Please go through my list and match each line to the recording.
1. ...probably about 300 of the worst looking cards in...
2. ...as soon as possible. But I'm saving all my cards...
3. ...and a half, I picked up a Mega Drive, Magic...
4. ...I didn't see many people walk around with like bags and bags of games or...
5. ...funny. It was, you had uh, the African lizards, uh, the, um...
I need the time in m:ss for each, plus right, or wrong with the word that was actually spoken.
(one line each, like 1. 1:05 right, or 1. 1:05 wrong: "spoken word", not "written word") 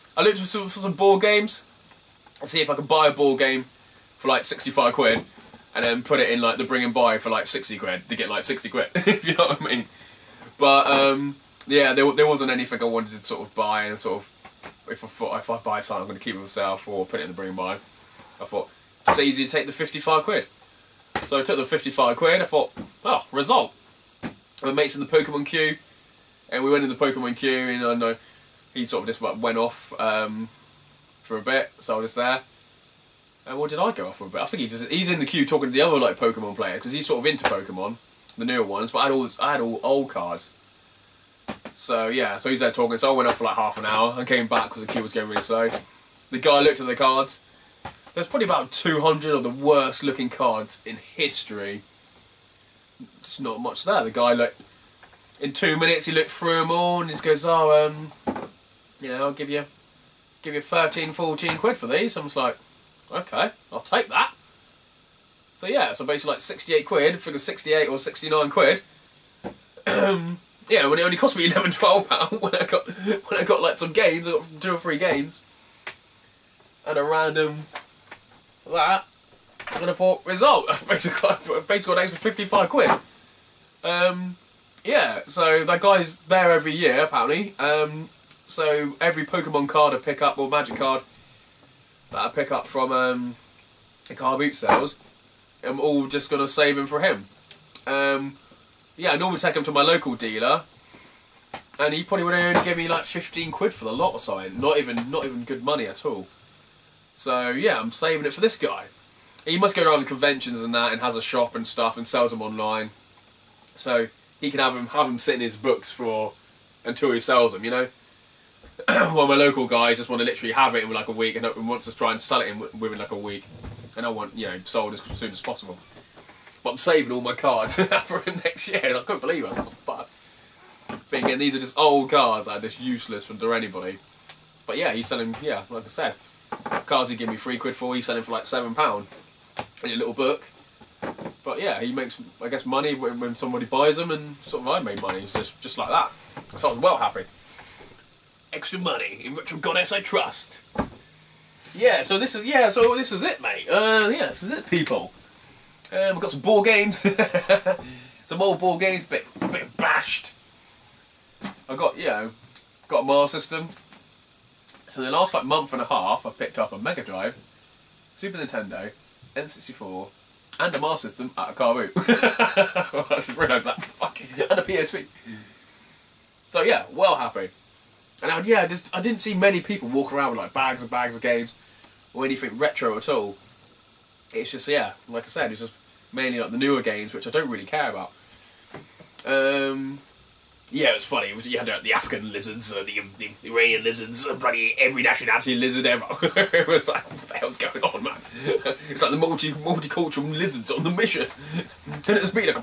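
1. 0:48 wrong: "200", not "300"
2. 2:04 right
3. 2:45 wrong: "Super", not "Magic"
4. 2:58 right
5. 3:11 right.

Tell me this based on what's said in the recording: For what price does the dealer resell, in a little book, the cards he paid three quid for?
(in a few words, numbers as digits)
7 pounds.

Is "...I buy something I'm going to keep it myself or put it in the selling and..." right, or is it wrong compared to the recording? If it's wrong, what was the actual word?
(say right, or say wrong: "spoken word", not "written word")
wrong: "bring", not "selling".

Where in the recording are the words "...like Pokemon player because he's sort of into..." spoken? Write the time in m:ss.
0:35.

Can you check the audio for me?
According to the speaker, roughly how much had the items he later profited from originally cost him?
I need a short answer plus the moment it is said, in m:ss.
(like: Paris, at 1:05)
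11 pounds, at 1:11.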